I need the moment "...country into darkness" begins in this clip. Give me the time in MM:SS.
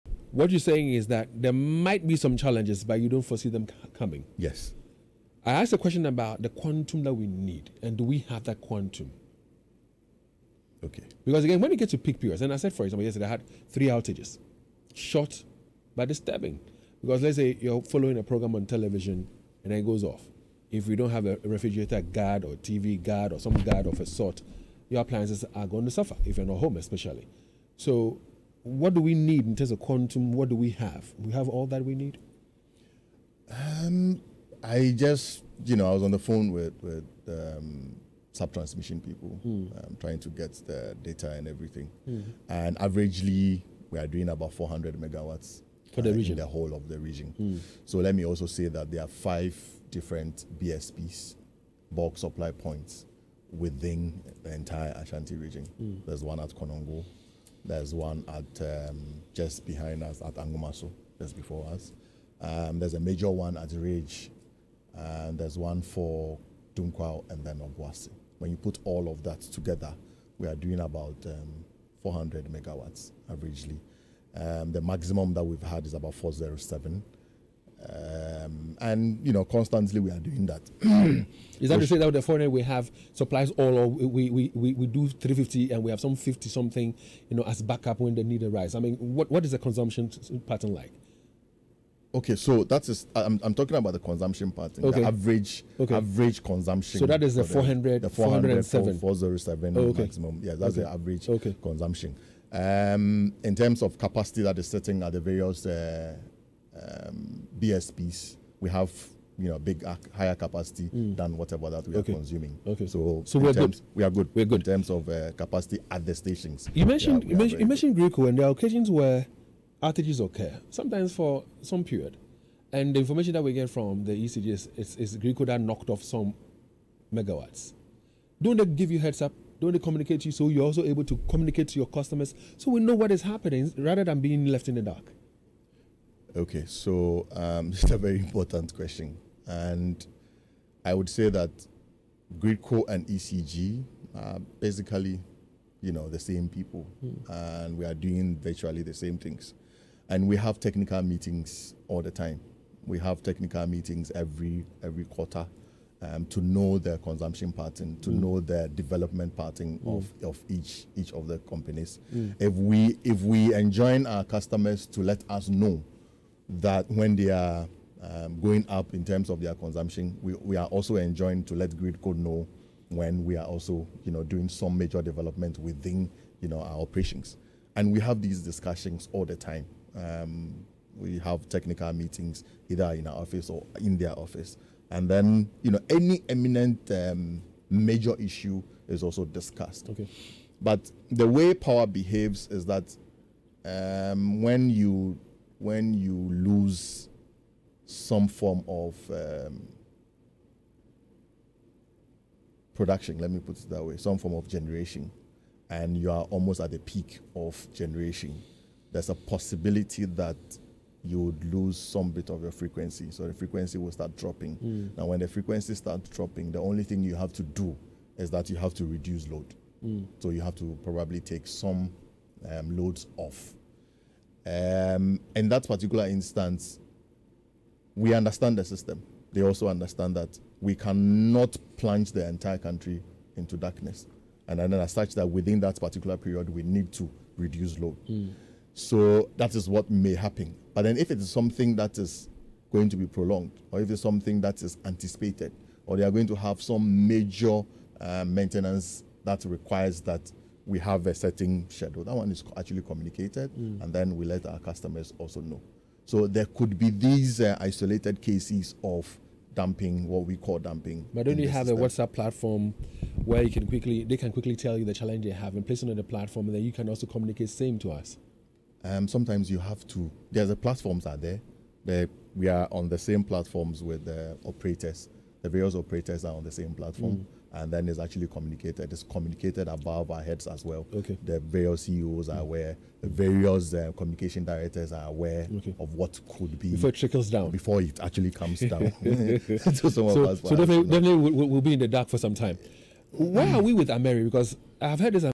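03:52.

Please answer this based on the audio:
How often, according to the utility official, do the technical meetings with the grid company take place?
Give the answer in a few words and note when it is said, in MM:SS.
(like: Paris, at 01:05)
every quarter, at 02:34.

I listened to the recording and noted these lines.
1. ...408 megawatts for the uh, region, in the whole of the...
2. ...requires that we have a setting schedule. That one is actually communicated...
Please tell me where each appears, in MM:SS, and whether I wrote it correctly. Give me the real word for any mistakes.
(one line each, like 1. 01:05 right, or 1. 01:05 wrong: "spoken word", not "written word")
1. 00:44 wrong: "400", not "408"
2. 04:09 right.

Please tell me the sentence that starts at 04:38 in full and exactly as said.
It's communicated above our heads as well.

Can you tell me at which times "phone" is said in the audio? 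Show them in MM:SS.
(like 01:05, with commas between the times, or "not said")
00:36.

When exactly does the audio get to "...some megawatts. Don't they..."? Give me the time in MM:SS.
02:06.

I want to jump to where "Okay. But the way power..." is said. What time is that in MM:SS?
03:09.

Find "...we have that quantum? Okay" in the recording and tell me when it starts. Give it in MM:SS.
00:08.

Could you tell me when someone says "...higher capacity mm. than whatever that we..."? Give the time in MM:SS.
01:50.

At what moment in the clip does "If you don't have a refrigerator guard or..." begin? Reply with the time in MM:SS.
00:20.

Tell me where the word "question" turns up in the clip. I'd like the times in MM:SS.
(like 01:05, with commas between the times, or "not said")
00:05, 02:18.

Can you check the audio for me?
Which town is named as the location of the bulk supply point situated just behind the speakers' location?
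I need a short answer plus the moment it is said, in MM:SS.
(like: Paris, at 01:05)
Anwomaso, at 01:00.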